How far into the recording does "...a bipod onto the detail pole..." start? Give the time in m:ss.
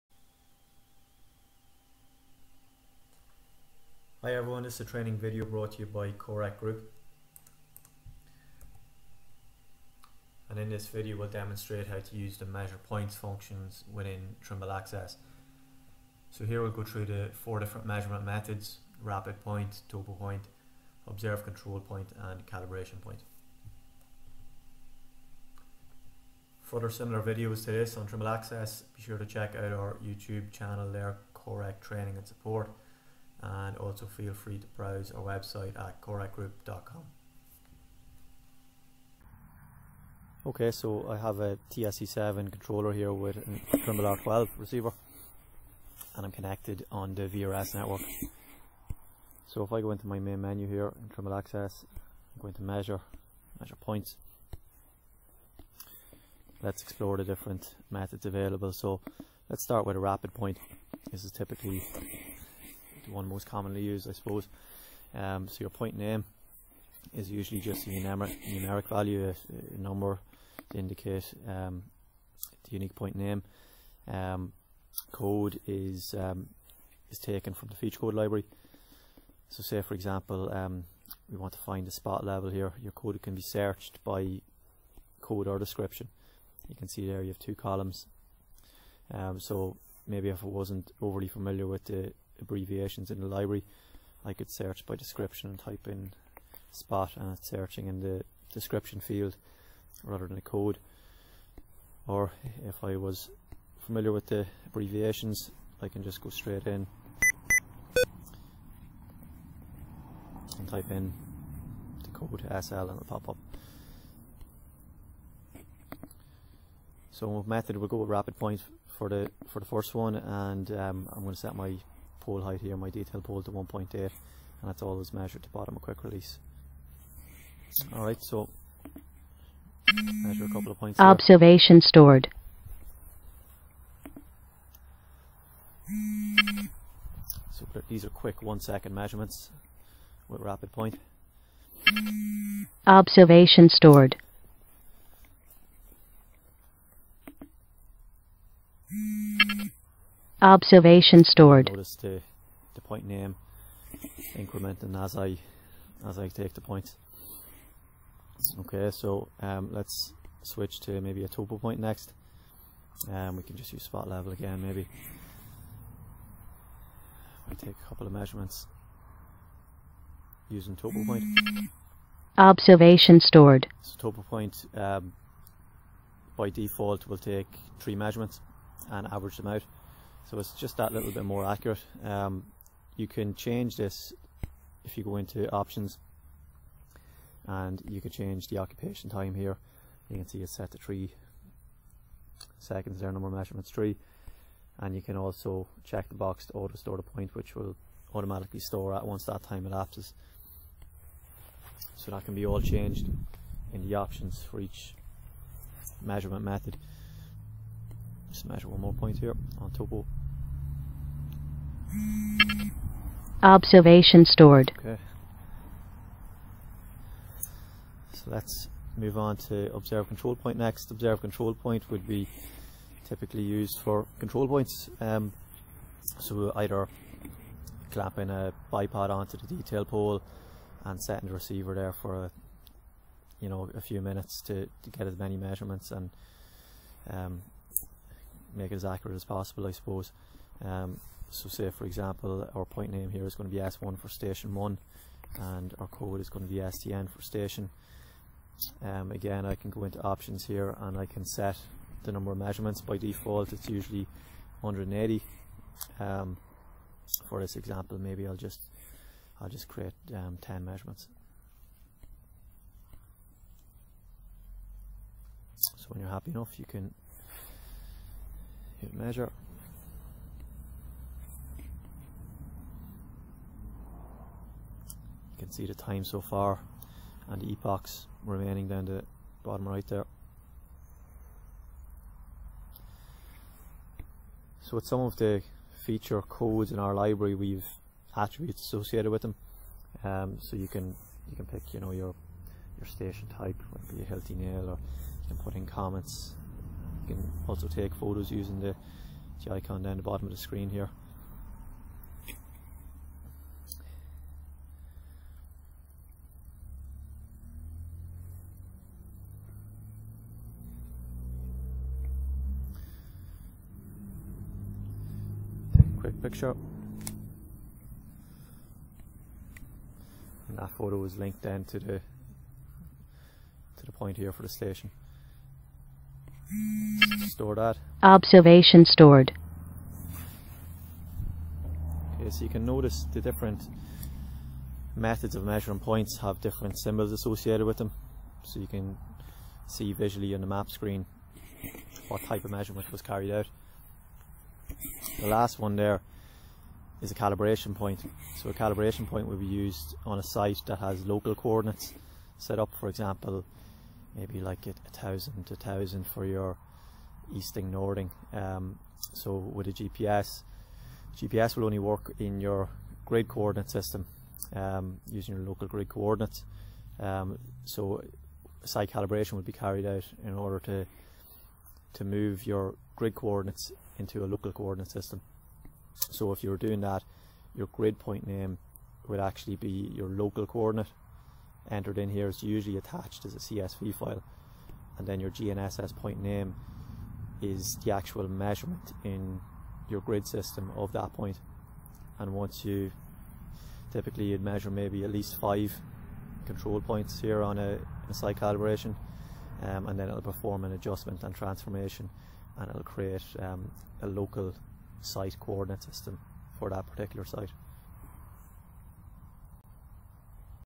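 3:48.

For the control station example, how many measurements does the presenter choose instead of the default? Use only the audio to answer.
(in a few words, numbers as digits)
10.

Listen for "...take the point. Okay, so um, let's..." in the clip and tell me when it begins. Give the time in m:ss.
2:36.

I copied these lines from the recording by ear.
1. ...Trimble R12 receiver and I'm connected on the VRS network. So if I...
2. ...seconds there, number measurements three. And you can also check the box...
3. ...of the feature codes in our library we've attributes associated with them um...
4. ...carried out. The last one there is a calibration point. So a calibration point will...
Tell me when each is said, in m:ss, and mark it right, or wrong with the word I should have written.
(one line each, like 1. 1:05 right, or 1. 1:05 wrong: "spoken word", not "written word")
1. 0:43 right
2. 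3:12 right
3. 4:45 right
4. 5:43 right.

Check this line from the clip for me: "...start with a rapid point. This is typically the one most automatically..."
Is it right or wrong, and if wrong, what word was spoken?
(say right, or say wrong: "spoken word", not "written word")
wrong: "commonly", not "automatically".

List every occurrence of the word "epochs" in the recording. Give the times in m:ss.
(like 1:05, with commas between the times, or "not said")
4:37.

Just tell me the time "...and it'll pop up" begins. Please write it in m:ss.
1:52.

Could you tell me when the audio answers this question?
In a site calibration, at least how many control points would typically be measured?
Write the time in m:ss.
6:35.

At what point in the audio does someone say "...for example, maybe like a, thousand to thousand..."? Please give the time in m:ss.
5:52.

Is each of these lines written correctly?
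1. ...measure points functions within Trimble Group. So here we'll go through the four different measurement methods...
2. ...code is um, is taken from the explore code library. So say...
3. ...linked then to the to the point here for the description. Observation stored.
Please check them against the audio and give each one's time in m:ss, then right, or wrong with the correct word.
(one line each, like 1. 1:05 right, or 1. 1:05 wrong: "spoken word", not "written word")
1. 0:12 wrong: "Access", not "Group"
2. 1:15 wrong: "feature", not "explore"
3. 5:21 wrong: "station", not "description".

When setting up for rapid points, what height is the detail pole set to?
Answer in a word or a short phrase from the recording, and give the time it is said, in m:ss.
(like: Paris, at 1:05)
1.8, at 2:03.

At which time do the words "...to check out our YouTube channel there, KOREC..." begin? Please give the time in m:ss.
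0:29.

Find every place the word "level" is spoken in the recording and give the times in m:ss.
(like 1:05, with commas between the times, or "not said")
1:22, 2:44.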